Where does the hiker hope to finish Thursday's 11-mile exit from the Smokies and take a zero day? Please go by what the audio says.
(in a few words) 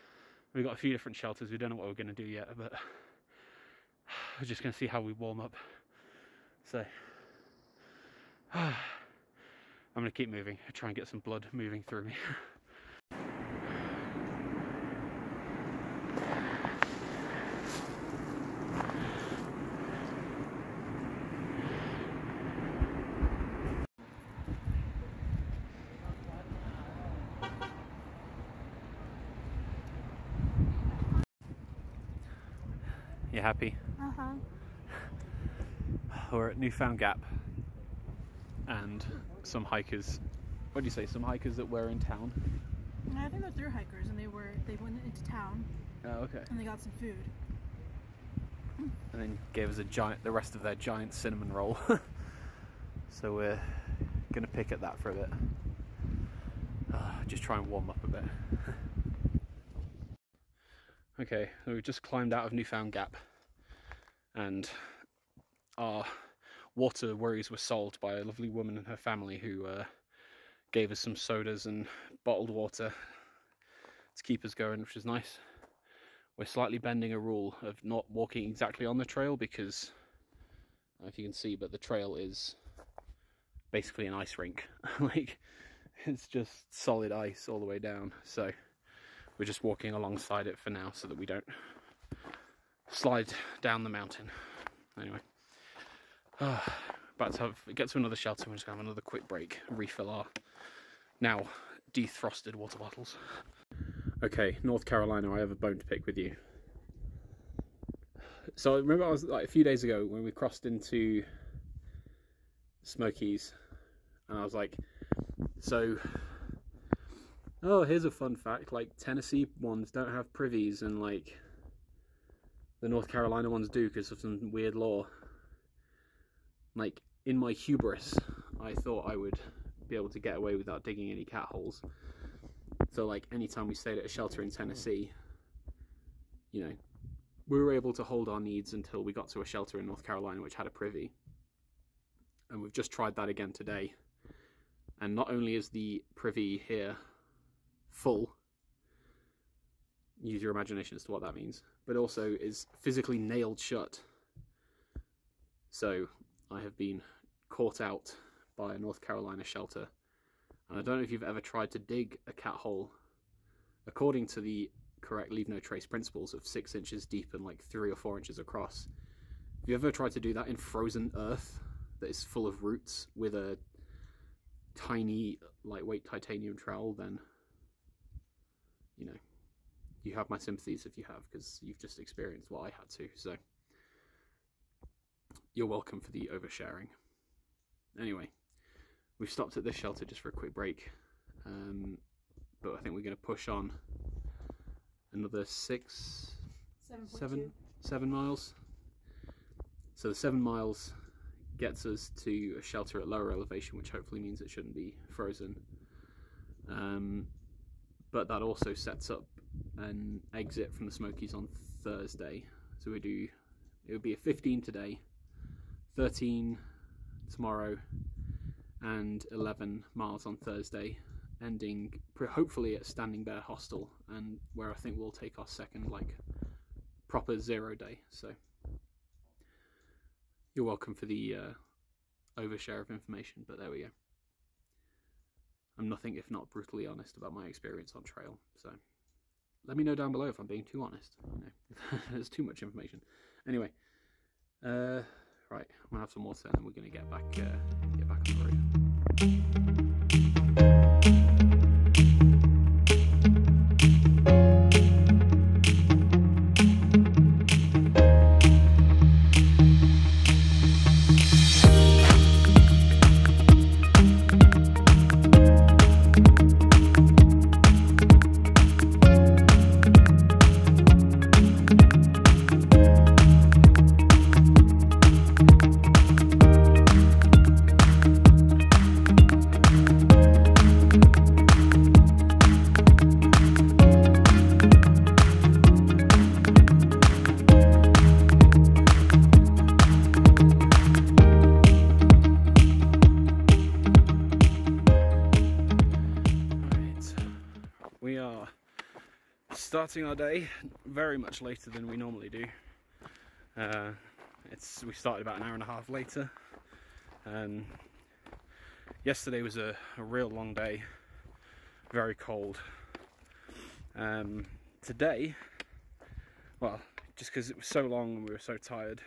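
Standing Bear Hostel.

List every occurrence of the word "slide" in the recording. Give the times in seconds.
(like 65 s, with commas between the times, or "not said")
92 s.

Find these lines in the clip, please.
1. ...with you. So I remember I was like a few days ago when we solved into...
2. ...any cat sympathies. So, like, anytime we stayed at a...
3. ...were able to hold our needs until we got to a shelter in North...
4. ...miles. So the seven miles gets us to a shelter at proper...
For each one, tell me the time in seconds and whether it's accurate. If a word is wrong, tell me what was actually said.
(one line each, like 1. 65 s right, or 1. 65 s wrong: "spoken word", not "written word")
1. 106 s wrong: "crossed", not "solved"
2. 131 s wrong: "holes", not "sympathies"
3. 137 s right
4. 198 s wrong: "lower", not "proper".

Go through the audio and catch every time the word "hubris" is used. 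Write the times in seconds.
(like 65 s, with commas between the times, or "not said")
127 s.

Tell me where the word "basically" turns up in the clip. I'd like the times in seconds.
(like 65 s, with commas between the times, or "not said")
83 s.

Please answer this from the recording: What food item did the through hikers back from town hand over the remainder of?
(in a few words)
Cinnamon roll.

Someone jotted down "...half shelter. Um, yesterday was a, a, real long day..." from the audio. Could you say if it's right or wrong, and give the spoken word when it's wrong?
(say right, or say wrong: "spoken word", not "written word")
wrong: "later", not "shelter".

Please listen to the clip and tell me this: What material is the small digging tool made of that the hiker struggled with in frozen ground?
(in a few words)
Titanium.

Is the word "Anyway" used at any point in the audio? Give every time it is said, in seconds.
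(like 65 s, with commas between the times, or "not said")
94 s, 187 s, 243 s.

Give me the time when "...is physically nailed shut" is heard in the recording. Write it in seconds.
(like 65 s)
152 s.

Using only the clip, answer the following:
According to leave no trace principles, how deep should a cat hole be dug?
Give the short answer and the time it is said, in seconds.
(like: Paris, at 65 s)
6 inches, at 166 s.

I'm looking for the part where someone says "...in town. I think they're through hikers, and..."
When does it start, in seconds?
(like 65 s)
41 s.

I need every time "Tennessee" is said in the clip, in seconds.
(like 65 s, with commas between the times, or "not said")
118 s, 134 s.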